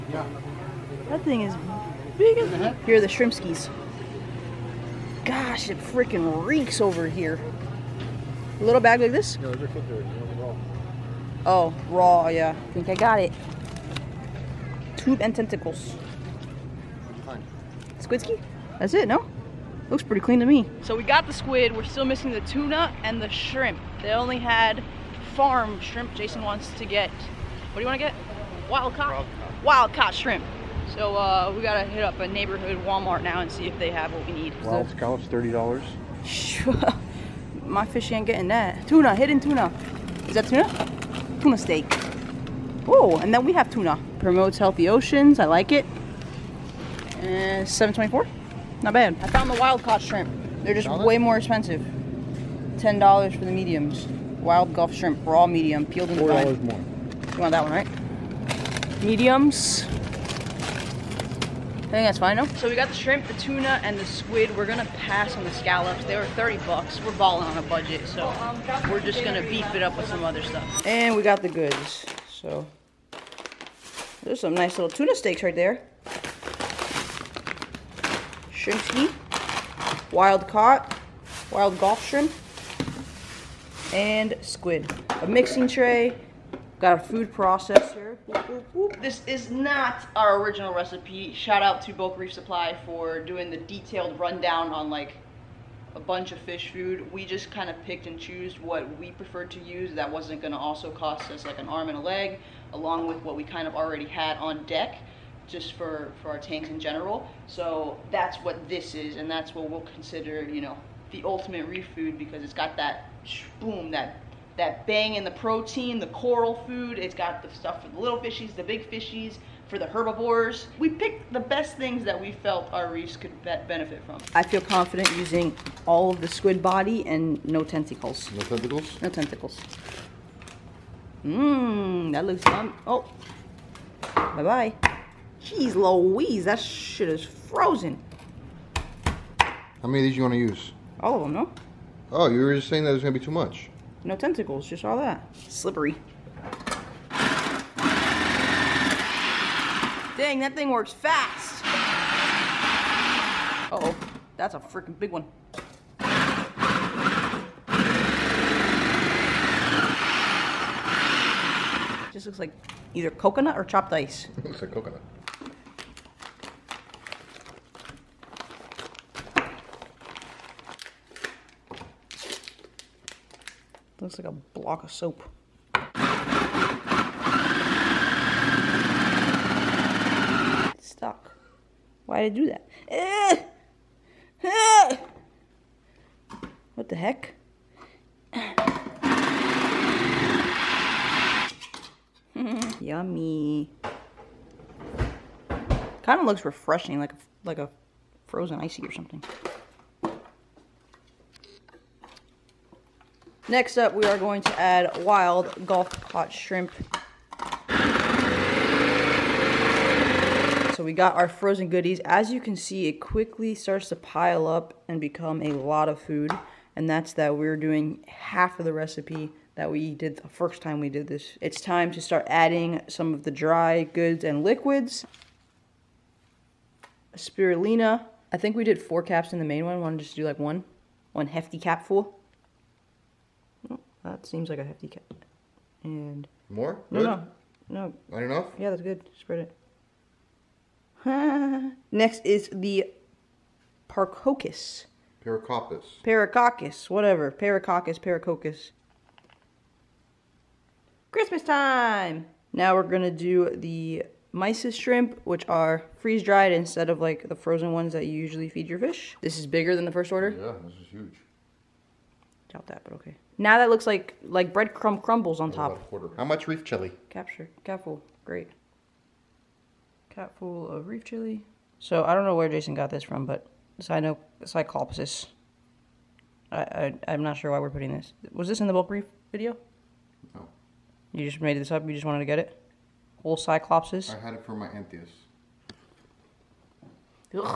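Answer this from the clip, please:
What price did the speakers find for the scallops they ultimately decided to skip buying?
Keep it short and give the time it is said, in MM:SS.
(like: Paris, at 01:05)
$30, at 00:34.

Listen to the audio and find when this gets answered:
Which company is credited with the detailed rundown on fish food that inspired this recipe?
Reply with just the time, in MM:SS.
01:31.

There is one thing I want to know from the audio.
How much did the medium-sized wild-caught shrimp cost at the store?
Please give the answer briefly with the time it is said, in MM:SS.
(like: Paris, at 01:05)
$10, at 00:52.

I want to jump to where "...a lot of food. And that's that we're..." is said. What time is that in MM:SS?
03:35.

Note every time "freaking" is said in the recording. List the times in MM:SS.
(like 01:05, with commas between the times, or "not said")
00:05, 02:34.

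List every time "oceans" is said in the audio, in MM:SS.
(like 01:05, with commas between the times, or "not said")
00:44.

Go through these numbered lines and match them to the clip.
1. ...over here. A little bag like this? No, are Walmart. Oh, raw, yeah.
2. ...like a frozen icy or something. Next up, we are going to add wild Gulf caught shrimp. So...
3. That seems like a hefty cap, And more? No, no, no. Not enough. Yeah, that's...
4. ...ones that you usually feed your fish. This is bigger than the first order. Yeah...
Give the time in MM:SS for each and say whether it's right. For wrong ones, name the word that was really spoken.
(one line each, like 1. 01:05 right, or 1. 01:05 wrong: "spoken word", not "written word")
1. 00:06 wrong: "Raw", not "Walmart"
2. 03:17 right
3. 03:54 right
4. 04:17 right.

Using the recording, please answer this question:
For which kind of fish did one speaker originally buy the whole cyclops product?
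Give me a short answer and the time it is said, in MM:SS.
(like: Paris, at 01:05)
Anthias, at 04:44.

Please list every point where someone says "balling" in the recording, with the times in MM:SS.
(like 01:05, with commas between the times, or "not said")
01:07.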